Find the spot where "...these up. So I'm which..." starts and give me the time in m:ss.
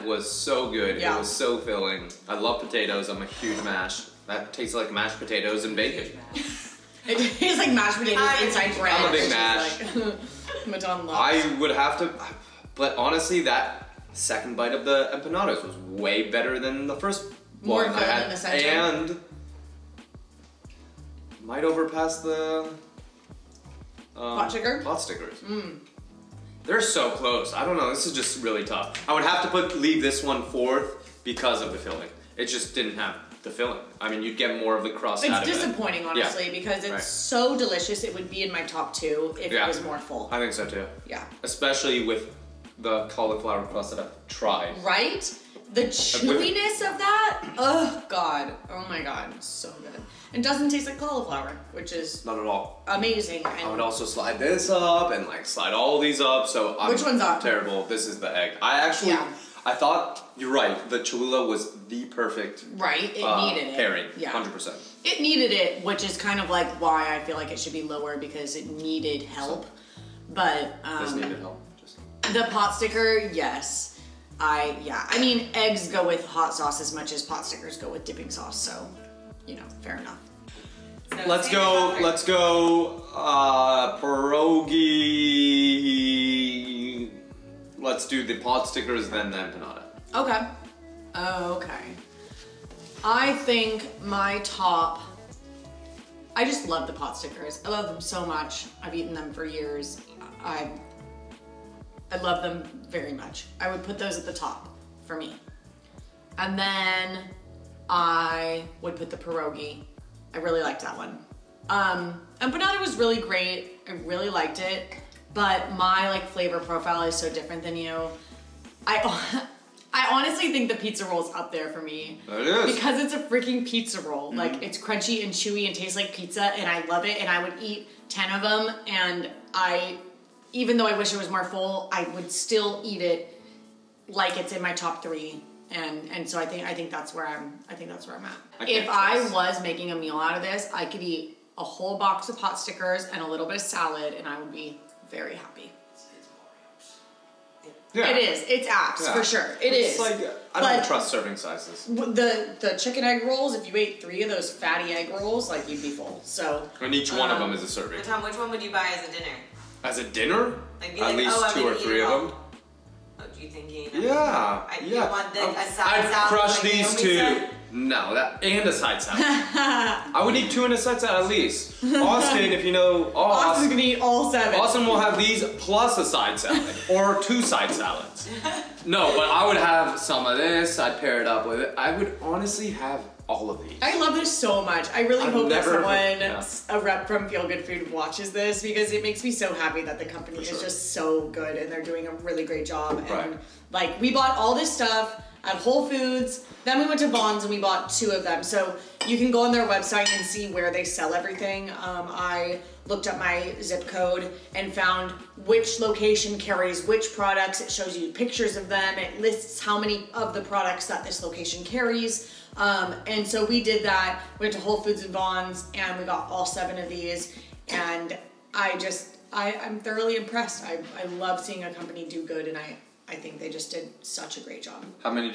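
0:55.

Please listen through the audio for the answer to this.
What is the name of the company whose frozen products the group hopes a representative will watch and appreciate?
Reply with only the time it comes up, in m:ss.
3:07.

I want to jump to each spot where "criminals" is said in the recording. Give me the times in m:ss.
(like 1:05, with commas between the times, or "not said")
not said.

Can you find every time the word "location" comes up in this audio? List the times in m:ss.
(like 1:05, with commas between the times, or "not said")
3:25, 3:31.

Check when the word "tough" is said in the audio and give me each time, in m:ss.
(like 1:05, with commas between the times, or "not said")
0:28.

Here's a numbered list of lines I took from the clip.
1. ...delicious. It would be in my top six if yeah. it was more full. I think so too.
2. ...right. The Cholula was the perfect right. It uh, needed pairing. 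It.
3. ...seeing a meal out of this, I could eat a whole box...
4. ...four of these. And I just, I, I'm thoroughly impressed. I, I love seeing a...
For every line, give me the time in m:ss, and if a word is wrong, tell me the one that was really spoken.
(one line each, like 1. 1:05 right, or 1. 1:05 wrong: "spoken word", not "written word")
1. 0:37 wrong: "two", not "six"
2. 1:00 right
3. 2:19 wrong: "making", not "seeing"
4. 3:36 wrong: "seven", not "four".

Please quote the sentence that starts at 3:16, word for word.
Then we went to Vons and we bought two of them.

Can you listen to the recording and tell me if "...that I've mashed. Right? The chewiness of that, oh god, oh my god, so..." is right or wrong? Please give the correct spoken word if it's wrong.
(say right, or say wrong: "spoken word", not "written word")
wrong: "tried", not "mashed".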